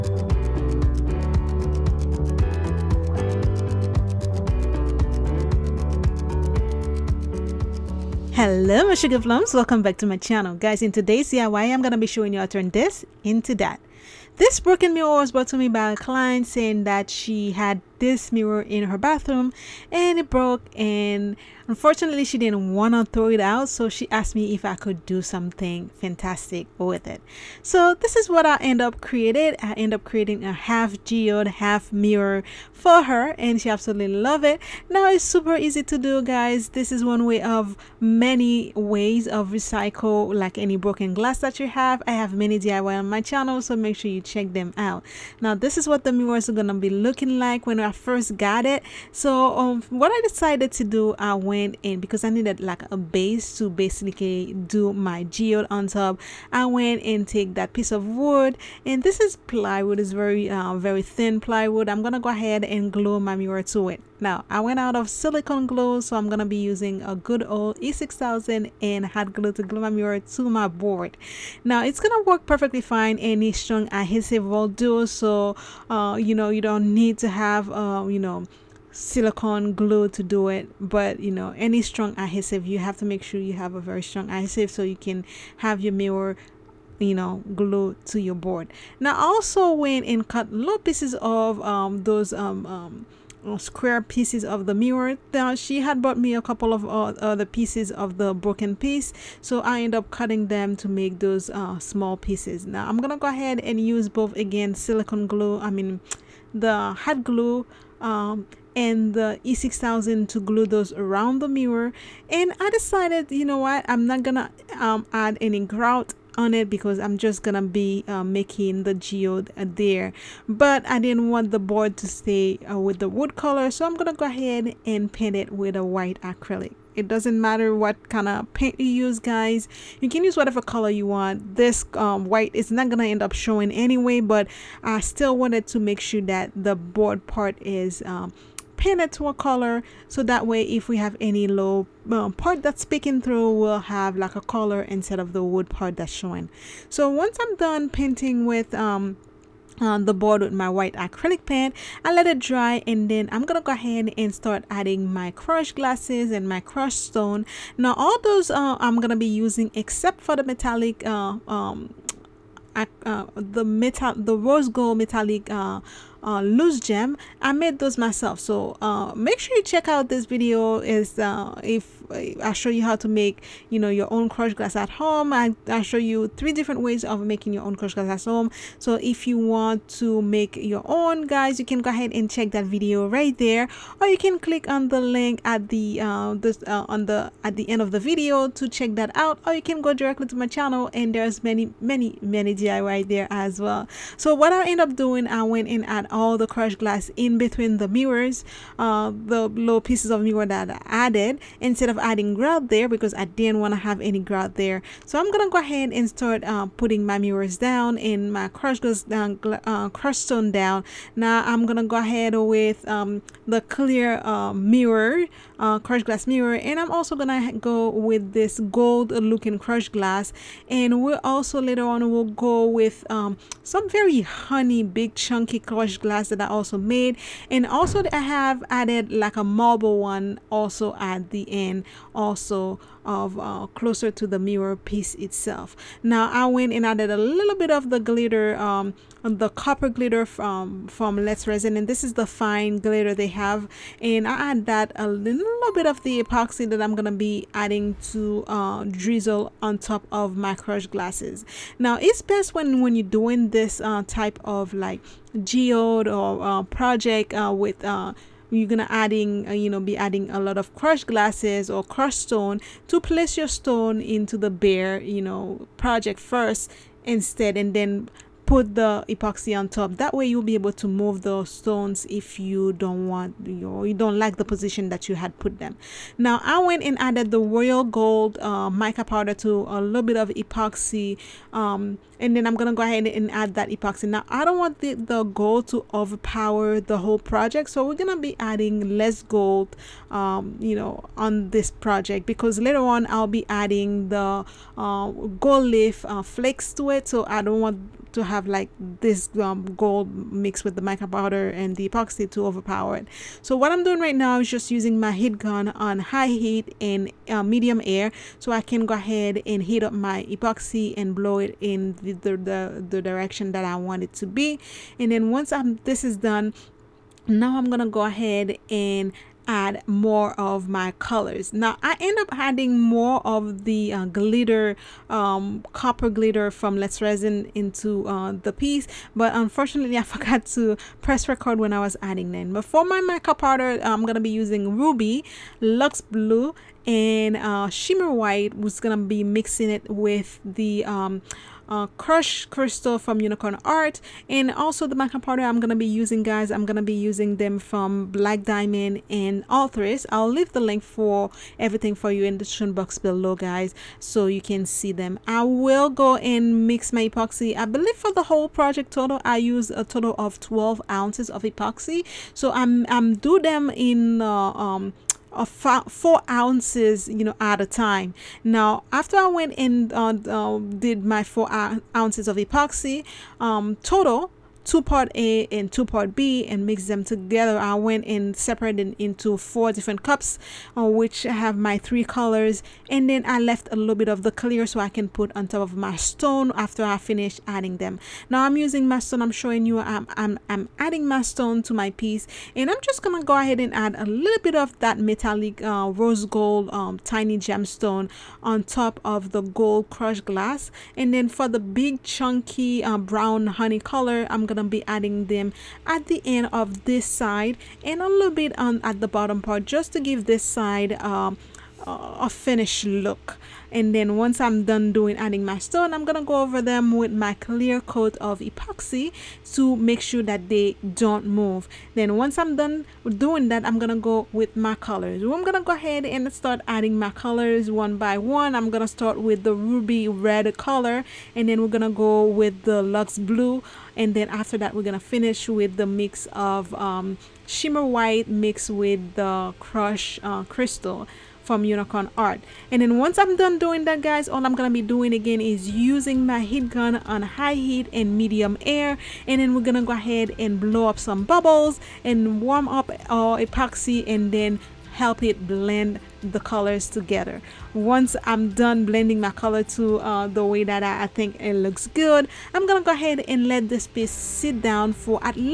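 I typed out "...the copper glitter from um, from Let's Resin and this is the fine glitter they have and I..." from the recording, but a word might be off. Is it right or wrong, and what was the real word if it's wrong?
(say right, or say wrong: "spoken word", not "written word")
right.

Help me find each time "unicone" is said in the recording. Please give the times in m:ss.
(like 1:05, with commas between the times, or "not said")
5:43, 7:21.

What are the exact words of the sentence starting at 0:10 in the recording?
Guys, in today's DIY, I'm going to be showing you how to turn this into that.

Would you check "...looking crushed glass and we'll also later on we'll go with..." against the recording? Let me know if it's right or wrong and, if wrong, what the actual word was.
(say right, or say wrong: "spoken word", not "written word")
right.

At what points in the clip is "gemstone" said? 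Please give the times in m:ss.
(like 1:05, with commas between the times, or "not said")
6:37.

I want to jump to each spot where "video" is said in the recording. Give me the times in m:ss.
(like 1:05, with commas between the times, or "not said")
2:50, 3:02, 3:07.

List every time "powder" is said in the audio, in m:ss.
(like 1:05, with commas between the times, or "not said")
4:39, 5:01, 5:33, 5:45.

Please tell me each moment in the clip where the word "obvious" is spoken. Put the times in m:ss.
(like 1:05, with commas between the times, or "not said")
not said.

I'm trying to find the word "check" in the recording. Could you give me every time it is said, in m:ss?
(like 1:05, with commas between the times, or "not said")
0:44, 2:49, 3:02, 3:08.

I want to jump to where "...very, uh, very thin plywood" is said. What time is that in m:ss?
1:00.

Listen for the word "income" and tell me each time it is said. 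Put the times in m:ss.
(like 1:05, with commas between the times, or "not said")
not said.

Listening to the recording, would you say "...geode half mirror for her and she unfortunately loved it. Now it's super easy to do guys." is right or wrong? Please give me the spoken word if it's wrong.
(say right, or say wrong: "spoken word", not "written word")
wrong: "absolutely", not "unfortunately".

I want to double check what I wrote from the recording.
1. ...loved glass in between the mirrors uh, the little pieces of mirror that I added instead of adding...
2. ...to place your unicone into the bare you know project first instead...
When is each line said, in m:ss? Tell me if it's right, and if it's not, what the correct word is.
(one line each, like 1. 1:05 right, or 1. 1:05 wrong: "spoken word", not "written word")
1. 3:16 wrong: "crushed", not "loved"
2. 4:22 wrong: "stone", not "unicone".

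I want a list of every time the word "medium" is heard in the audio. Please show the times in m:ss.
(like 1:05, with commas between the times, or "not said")
5:07, 7:28.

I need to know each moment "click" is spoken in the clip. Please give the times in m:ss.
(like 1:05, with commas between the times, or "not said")
3:04.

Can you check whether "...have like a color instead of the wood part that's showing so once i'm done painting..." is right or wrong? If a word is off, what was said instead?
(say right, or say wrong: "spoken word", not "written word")
right.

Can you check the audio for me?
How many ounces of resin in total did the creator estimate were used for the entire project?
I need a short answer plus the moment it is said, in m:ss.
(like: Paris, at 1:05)
12, at 6:00.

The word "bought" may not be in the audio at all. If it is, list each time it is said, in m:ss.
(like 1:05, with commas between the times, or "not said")
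1:35.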